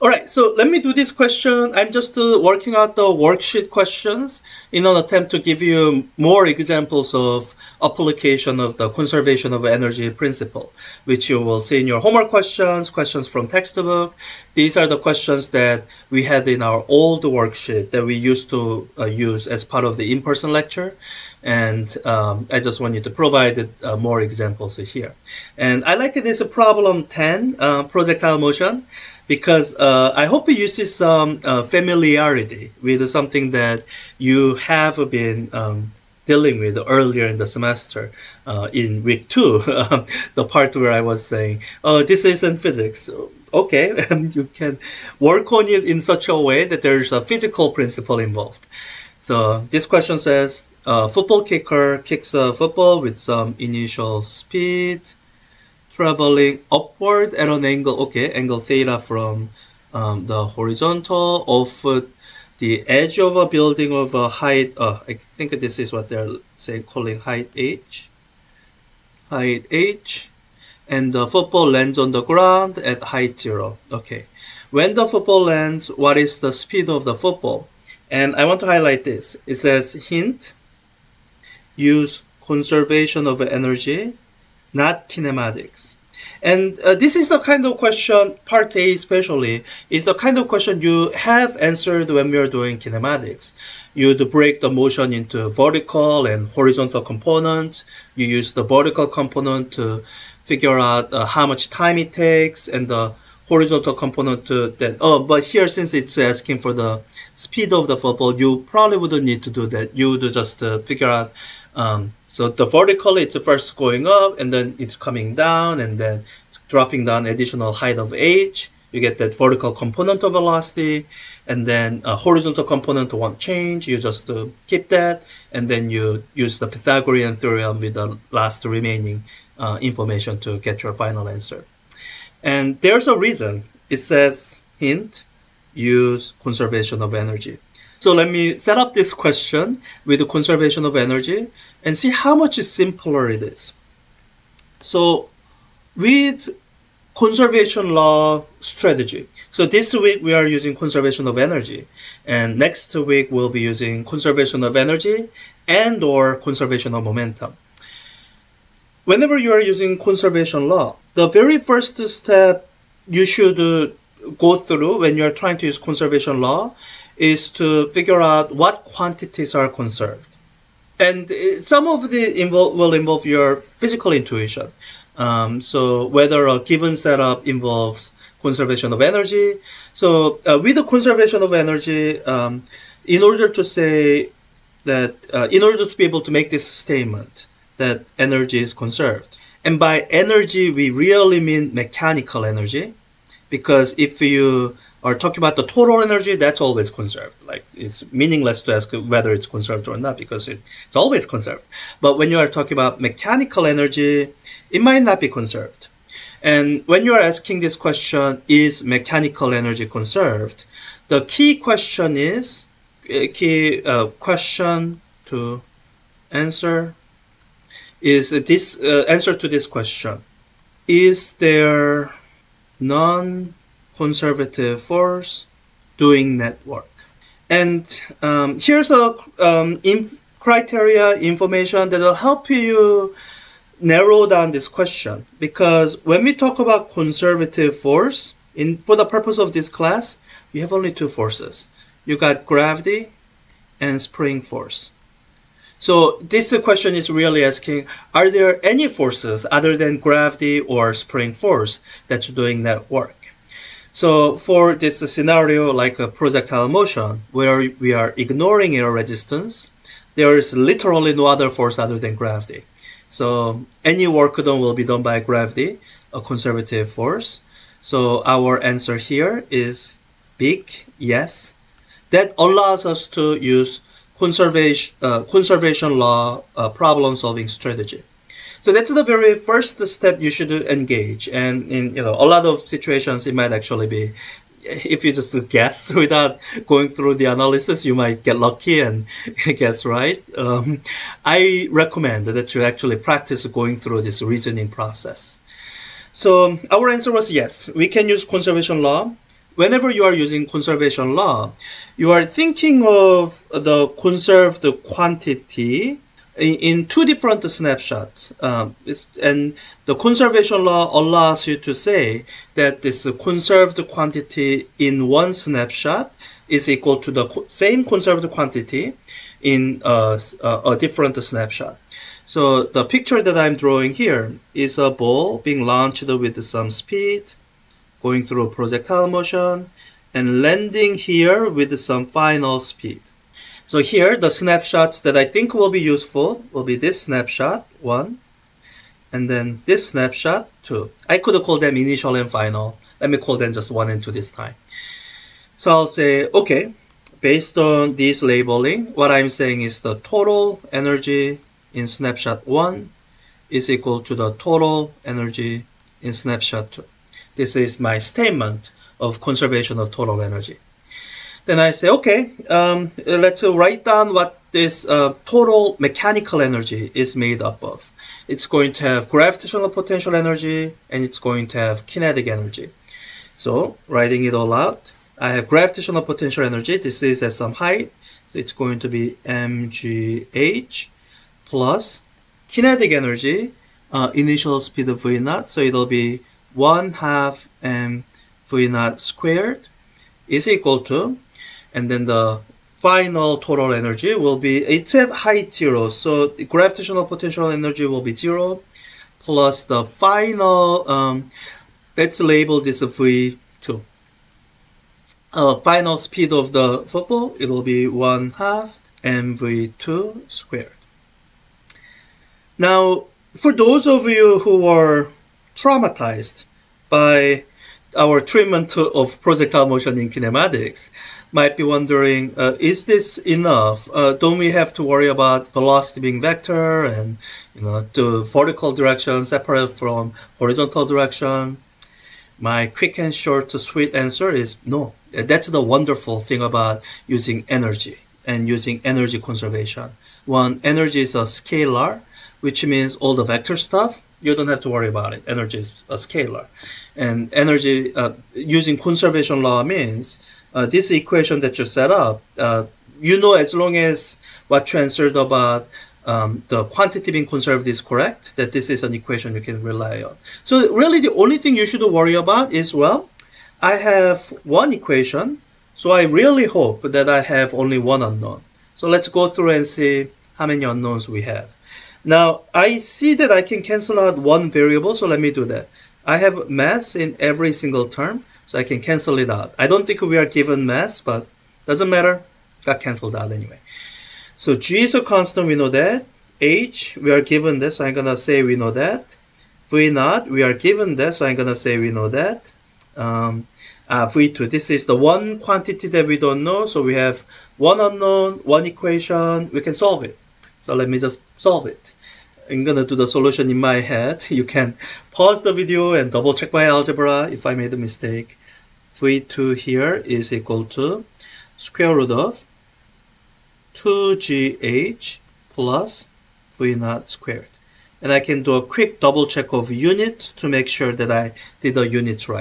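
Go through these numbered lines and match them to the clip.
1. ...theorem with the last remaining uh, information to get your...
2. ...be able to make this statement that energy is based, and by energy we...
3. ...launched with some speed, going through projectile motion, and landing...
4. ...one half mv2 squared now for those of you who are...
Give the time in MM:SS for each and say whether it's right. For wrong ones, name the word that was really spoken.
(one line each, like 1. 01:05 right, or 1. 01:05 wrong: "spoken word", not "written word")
1. 02:07 right
2. 03:05 wrong: "conserved", not "based"
3. 05:25 right
4. 06:47 right.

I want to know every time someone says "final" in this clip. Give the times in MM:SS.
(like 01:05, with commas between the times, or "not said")
02:10, 05:32, 05:42, 06:32, 06:39, 06:45.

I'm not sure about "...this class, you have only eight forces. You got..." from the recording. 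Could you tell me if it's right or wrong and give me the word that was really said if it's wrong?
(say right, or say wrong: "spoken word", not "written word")
wrong: "two", not "eight".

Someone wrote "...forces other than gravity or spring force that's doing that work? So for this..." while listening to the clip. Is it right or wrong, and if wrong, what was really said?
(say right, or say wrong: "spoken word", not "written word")
right.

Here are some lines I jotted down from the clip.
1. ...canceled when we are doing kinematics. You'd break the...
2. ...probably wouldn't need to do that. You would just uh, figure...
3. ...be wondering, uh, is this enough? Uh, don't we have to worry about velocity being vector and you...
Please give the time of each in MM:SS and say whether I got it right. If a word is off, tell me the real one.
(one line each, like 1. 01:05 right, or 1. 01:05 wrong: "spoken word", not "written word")
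1. 01:31 wrong: "answered", not "canceled"
2. 01:48 right
3. 07:01 right.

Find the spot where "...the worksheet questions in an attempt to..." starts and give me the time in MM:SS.
00:02.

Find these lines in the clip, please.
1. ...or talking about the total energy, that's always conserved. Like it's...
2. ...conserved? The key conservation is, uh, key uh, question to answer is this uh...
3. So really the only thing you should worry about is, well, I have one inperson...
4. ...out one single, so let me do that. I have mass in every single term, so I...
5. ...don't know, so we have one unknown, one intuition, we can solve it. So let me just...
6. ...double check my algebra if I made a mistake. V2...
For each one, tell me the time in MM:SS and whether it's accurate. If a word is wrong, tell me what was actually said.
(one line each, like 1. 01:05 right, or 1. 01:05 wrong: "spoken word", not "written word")
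1. 03:15 right
2. 03:29 wrong: "question", not "conservation"
3. 07:40 wrong: "equation", not "inperson"
4. 07:54 wrong: "variable", not "single"
5. 08:16 wrong: "equation", not "intuition"
6. 08:26 right.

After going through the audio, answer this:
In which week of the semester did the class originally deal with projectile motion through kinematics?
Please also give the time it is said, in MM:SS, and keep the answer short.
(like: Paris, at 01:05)
week two, at 00:39.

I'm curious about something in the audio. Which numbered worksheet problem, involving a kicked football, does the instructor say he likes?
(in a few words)
10.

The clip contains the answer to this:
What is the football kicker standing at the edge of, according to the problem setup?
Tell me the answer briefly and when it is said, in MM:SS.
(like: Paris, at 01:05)
a building, at 01:03.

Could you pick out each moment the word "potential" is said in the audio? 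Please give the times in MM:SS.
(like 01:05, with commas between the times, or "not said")
06:09, 06:16, 06:37.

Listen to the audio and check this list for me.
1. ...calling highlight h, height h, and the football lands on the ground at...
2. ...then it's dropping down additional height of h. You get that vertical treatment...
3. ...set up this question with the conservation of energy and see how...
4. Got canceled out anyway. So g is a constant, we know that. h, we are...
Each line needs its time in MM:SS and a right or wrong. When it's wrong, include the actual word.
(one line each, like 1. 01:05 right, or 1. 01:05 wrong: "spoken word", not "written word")
1. 01:06 wrong: "height", not "highlight"
2. 01:55 wrong: "component", not "treatment"
3. 02:18 right
4. 08:02 right.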